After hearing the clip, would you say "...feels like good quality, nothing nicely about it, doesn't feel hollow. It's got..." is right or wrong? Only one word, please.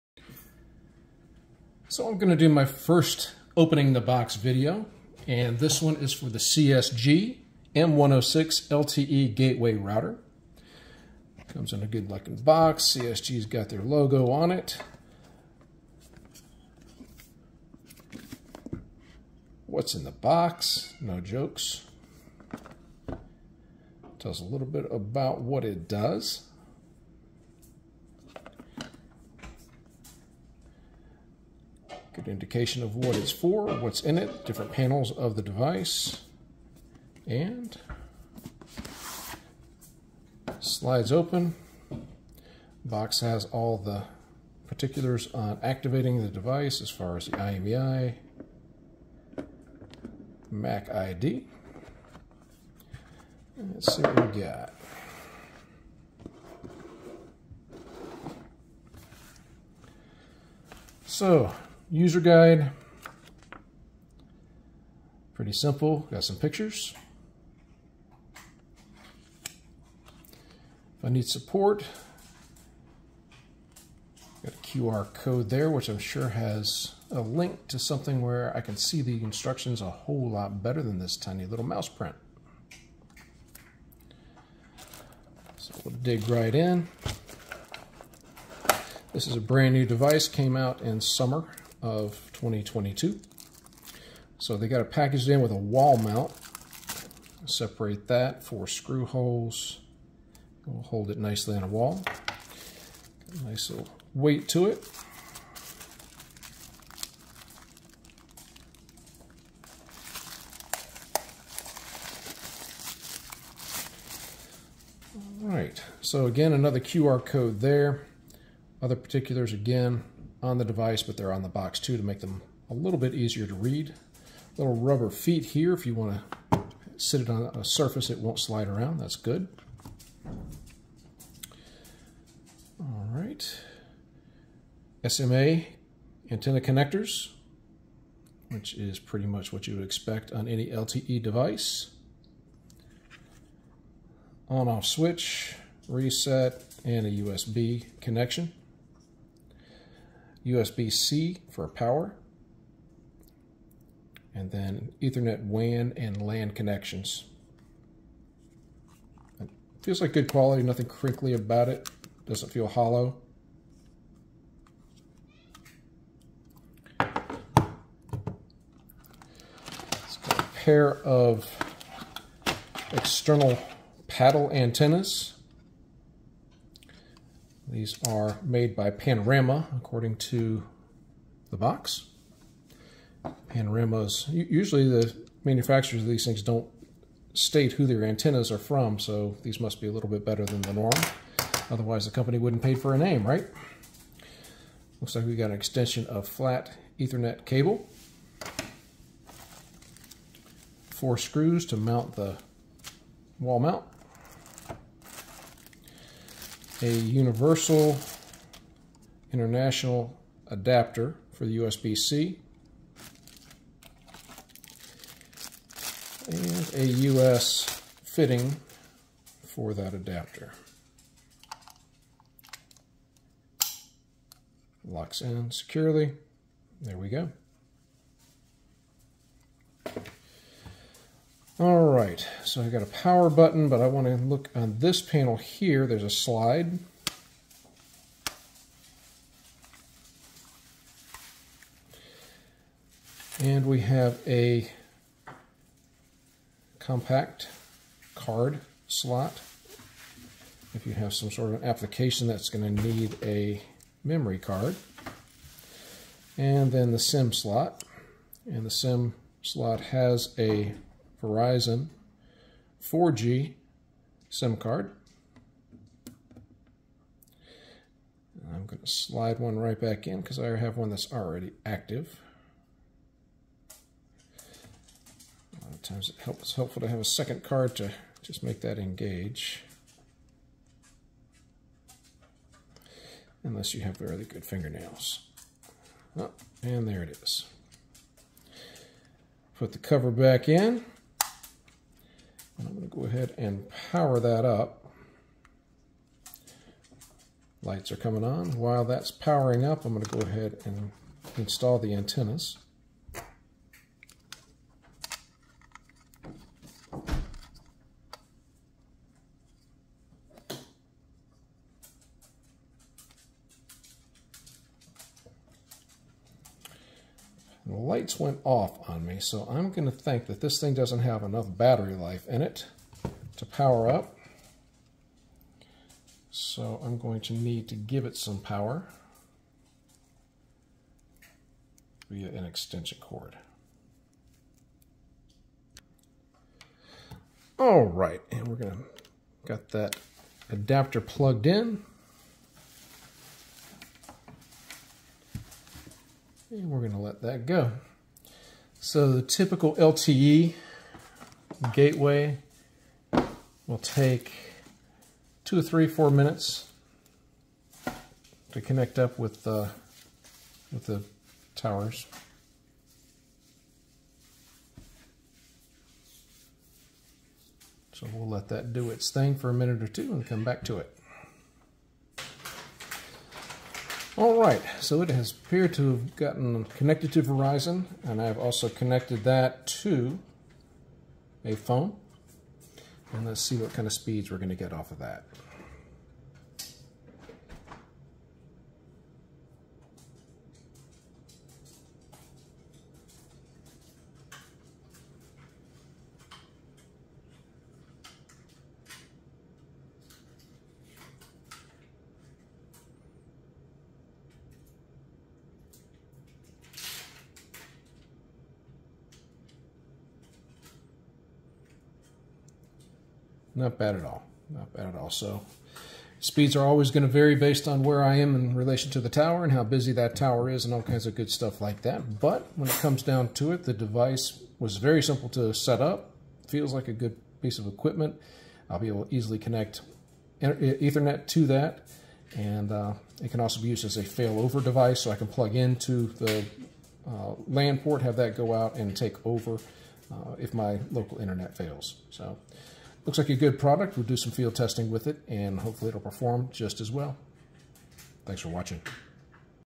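wrong.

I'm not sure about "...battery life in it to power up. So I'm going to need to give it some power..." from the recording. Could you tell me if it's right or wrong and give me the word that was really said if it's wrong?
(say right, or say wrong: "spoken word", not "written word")
right.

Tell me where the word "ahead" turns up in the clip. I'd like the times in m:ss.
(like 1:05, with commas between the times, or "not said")
4:53, 5:00.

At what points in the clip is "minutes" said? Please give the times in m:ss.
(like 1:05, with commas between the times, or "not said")
5:56, 6:09.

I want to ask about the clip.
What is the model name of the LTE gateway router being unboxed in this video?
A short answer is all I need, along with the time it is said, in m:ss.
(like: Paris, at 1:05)
CSG M160, at 0:06.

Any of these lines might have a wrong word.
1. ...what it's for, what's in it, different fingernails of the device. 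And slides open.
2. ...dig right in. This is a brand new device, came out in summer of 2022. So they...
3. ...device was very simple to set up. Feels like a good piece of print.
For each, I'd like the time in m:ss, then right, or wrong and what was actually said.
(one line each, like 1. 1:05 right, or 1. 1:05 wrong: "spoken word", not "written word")
1. 0:32 wrong: "panels", not "fingernails"
2. 1:25 right
3. 7:03 wrong: "equipment", not "print".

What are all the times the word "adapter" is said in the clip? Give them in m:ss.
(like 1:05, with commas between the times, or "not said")
3:30, 3:39, 5:40.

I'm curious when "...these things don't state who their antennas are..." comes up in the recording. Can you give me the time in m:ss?
3:06.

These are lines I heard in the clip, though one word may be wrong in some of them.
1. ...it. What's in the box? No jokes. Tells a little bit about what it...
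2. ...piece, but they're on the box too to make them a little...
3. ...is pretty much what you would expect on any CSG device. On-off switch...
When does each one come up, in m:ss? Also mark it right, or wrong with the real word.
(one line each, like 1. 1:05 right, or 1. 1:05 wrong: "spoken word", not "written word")
1. 0:14 right
2. 2:00 wrong: "device", not "piece"
3. 2:18 wrong: "LTE", not "CSG".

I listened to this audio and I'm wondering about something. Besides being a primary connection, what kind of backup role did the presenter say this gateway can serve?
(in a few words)
failover device.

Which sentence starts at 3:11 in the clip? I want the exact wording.
Otherwise, the company wouldn't pay for a name, right?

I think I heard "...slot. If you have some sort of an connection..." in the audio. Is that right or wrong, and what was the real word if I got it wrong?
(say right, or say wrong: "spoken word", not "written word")
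wrong: "application", not "connection".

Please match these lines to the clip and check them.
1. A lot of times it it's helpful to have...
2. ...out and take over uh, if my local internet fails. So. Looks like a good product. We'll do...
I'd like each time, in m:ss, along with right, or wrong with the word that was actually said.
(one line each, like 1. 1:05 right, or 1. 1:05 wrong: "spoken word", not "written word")
1. 4:35 right
2. 7:18 right.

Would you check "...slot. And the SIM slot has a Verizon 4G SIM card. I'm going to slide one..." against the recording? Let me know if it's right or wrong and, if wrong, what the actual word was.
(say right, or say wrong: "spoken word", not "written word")
right.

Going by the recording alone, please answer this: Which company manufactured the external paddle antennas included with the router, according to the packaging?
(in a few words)
Panorama.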